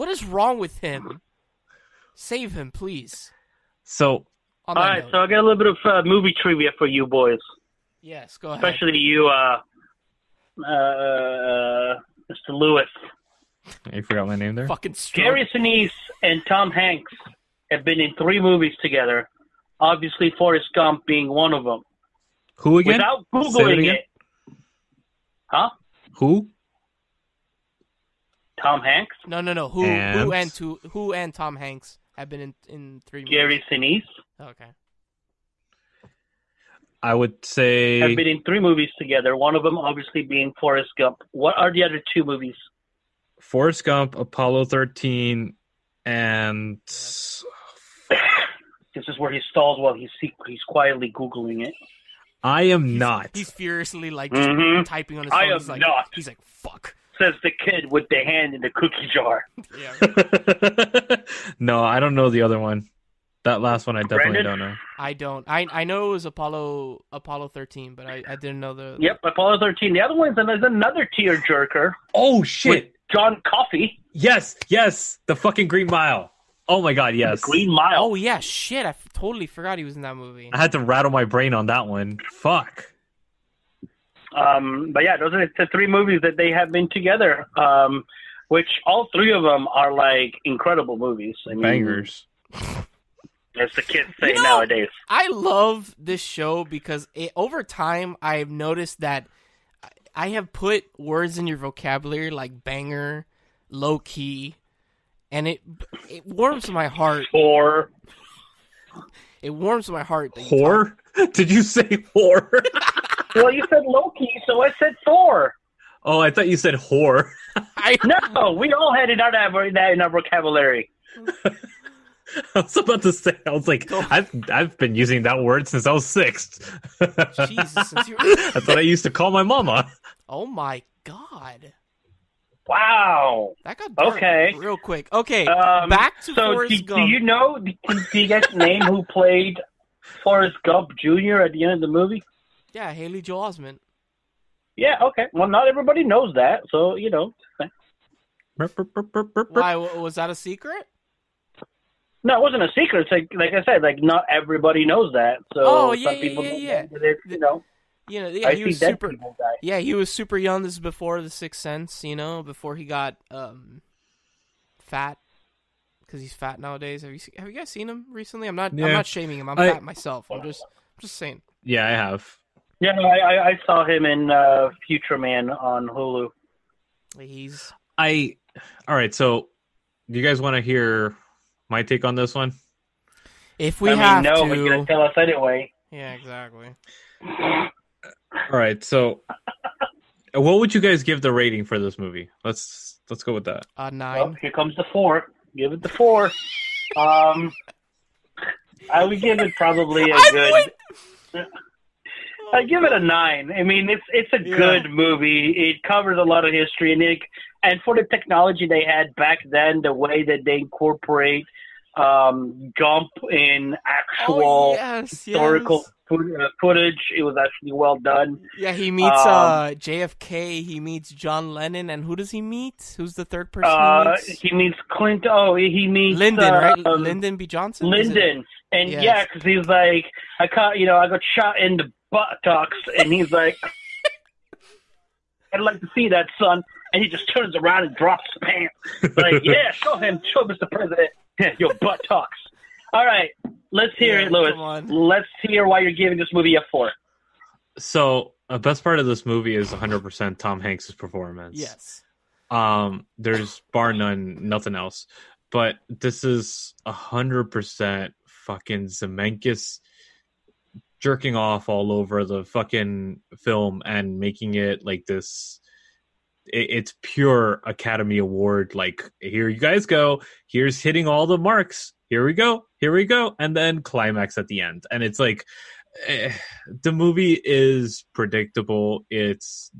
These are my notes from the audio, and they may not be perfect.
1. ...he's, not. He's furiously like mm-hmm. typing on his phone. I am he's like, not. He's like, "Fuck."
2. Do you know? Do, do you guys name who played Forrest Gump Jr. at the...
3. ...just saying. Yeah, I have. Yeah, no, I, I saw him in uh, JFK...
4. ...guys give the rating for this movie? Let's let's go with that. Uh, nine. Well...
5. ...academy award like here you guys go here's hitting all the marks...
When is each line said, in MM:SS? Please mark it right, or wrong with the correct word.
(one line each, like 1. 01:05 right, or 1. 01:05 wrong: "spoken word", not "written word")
1. 00:52 right
2. 02:17 right
3. 02:51 wrong: "Future", not "JFK"
4. 03:10 right
5. 04:27 right.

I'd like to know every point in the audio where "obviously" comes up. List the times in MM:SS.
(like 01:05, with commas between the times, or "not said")
00:19, 00:39.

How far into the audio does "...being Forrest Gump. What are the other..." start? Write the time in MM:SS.
00:40.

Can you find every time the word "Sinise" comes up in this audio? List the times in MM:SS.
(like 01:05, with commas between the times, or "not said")
00:15, 00:33.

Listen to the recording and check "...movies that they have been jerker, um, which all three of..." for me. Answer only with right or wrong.
wrong.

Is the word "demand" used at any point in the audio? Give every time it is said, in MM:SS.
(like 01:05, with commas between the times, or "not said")
not said.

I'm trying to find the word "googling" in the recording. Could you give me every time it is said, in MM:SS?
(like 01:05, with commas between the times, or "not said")
00:23, 00:51.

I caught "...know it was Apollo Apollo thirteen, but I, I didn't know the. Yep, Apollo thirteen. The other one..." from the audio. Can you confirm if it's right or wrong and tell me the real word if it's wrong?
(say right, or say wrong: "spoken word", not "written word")
right.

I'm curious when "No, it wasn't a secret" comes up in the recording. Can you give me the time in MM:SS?
02:32.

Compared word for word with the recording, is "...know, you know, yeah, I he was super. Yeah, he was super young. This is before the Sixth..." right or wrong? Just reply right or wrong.
right.